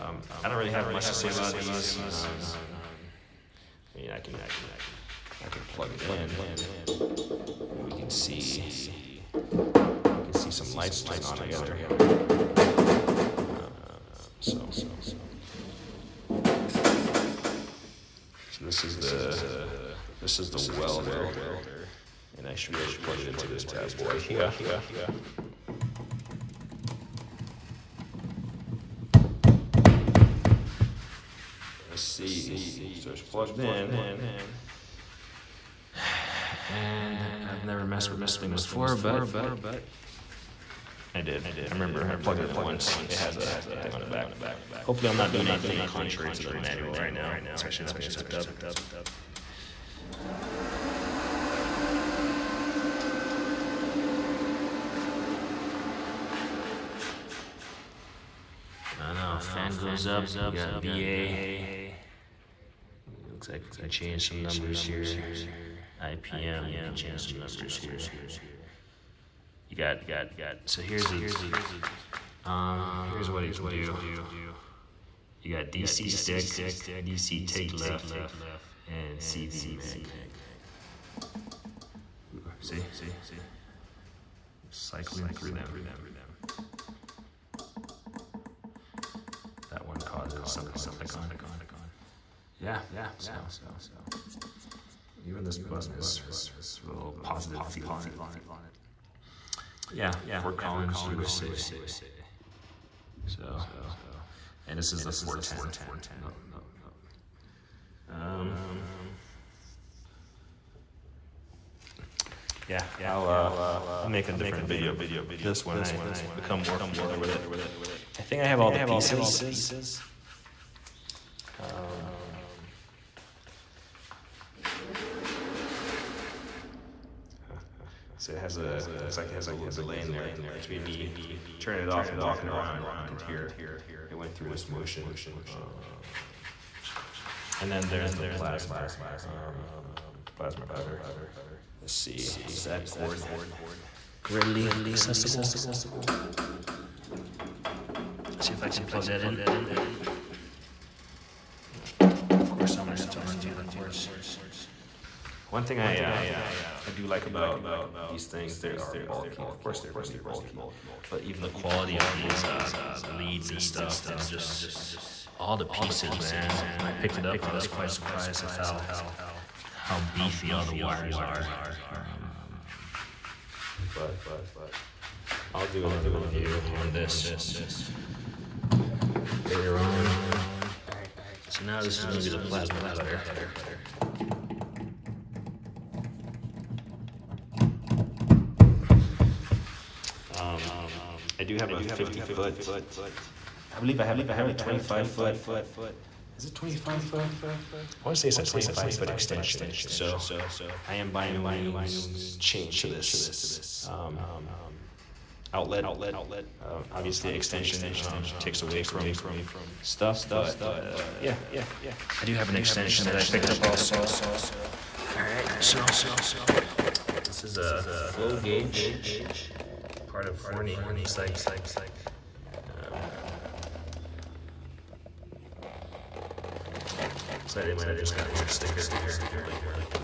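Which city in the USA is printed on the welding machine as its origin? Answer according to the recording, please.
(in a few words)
Fort Collins.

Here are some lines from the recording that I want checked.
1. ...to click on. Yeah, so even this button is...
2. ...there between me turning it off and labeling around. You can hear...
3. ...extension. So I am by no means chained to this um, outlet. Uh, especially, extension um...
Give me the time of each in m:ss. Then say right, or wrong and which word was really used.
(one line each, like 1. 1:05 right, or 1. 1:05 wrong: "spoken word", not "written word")
1. 1:30 right
2. 2:10 wrong: "walking", not "labeling"
3. 3:19 wrong: "obviously", not "especially".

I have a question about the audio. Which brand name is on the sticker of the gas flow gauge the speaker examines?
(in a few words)
Forney.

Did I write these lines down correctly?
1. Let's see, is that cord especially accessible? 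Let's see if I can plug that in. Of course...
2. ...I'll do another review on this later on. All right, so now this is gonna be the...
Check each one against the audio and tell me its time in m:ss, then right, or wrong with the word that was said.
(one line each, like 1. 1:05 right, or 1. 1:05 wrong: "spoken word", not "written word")
1. 2:21 wrong: "readily", not "especially"
2. 2:55 right.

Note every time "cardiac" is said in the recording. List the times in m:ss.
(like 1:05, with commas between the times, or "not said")
not said.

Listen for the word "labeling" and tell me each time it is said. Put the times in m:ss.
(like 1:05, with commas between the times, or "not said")
3:49.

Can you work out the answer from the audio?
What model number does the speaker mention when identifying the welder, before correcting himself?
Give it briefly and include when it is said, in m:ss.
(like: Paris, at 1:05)
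410, at 1:45.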